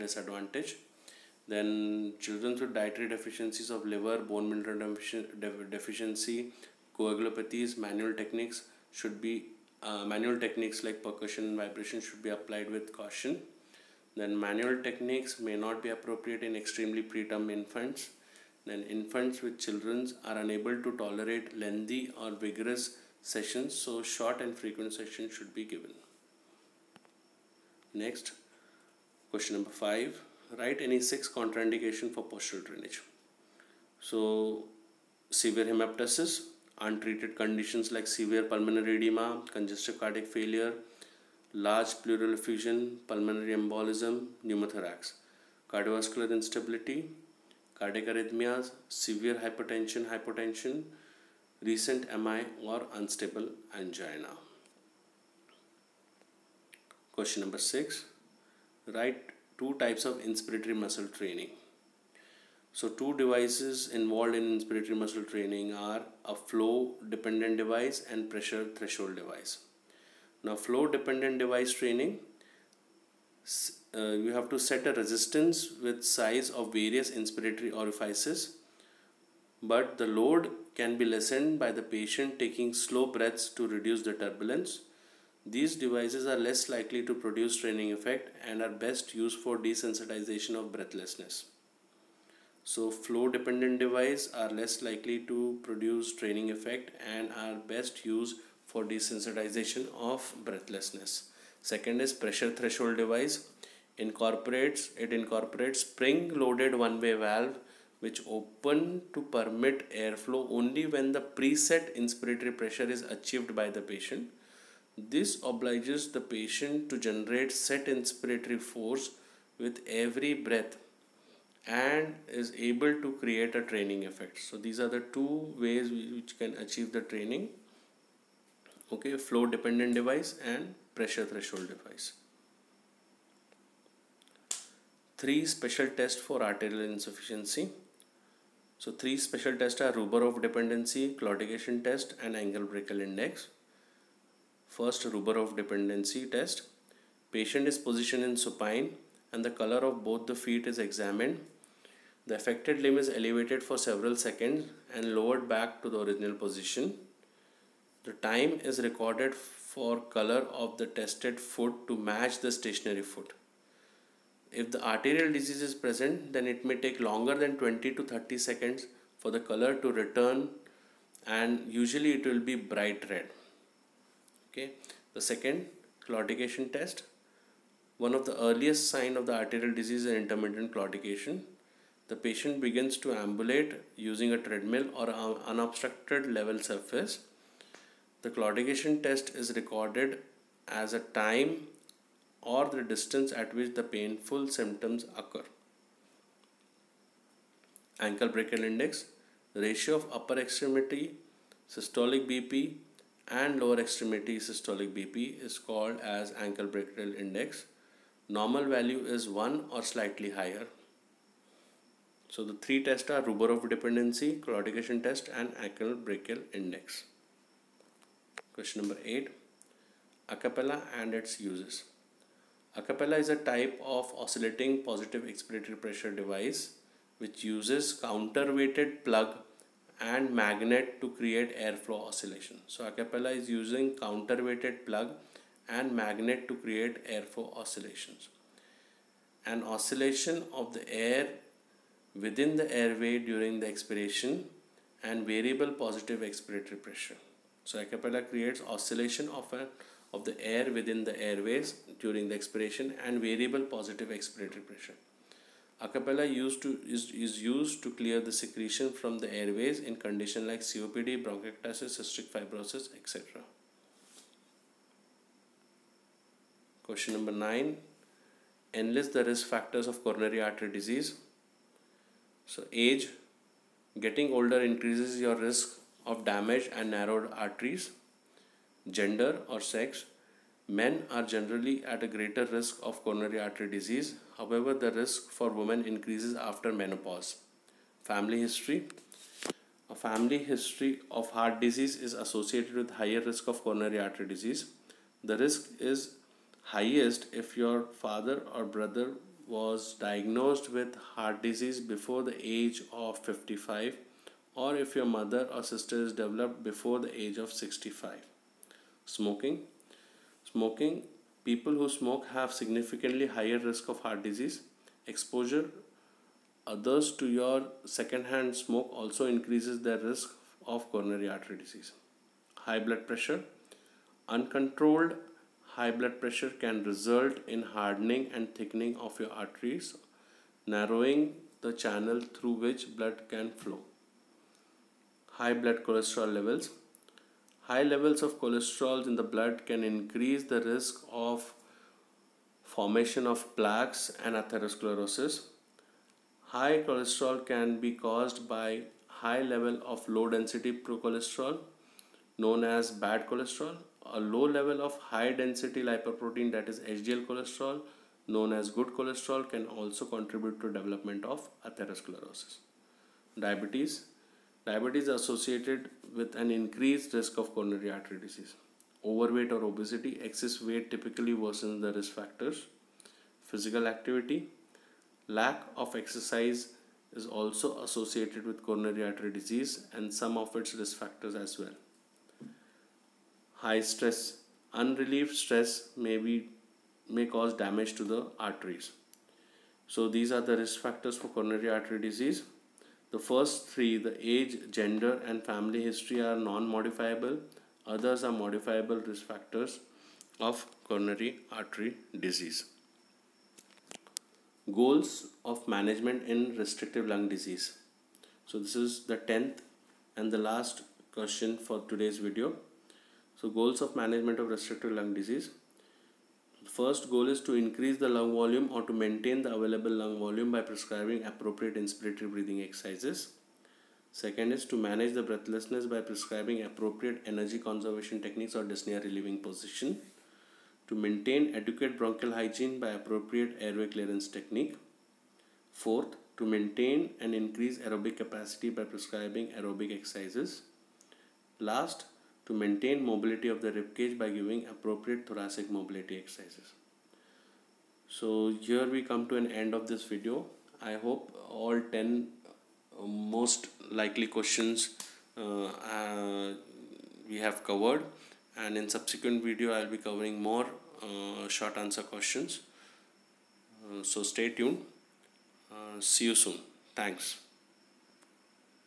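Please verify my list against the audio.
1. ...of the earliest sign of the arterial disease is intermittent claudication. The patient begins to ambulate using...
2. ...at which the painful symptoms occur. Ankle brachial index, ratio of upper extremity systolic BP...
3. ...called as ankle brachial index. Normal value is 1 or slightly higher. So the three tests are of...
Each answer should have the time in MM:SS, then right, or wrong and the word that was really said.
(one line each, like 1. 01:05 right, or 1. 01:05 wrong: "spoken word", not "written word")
1. 02:58 right
2. 03:13 right
3. 03:25 right.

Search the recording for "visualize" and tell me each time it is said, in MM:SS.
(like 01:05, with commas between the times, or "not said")
not said.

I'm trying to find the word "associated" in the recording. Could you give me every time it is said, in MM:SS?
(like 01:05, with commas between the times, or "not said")
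04:52, 06:05, 06:17.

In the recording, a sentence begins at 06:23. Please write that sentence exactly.
High stress, unrelieved stress may be may cause damage to the arteries.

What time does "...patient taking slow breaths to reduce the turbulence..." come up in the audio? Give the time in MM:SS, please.
01:21.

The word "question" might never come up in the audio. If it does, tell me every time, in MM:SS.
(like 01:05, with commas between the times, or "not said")
00:29, 00:57, 03:38, 04:26, 06:51, 07:34, 07:42.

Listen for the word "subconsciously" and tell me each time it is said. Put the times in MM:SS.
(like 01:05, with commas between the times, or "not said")
not said.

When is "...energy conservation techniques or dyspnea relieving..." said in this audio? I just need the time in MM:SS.
07:07.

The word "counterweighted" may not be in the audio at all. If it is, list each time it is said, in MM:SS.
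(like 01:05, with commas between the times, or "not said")
03:48, 03:53.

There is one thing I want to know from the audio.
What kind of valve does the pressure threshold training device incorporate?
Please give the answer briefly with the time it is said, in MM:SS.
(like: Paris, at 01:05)
Spring-loaded one-way valve, at 01:45.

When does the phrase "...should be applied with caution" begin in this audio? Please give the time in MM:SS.
00:11.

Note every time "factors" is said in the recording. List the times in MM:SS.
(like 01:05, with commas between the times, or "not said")
04:29, 06:12, 06:20, 06:30, 06:39.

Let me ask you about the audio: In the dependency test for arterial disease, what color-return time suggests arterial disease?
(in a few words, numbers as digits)
20 to 30 seconds.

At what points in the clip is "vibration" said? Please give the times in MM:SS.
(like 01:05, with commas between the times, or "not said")
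00:11.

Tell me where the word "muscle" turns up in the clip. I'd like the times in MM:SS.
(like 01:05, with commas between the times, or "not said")
01:00, 01:04.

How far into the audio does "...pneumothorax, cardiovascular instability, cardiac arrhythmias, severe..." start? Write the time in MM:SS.
00:44.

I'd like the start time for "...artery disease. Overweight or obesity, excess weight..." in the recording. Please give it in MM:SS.
06:07.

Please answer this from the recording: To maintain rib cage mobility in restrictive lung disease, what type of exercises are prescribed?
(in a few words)
Thoracic mobility exercises.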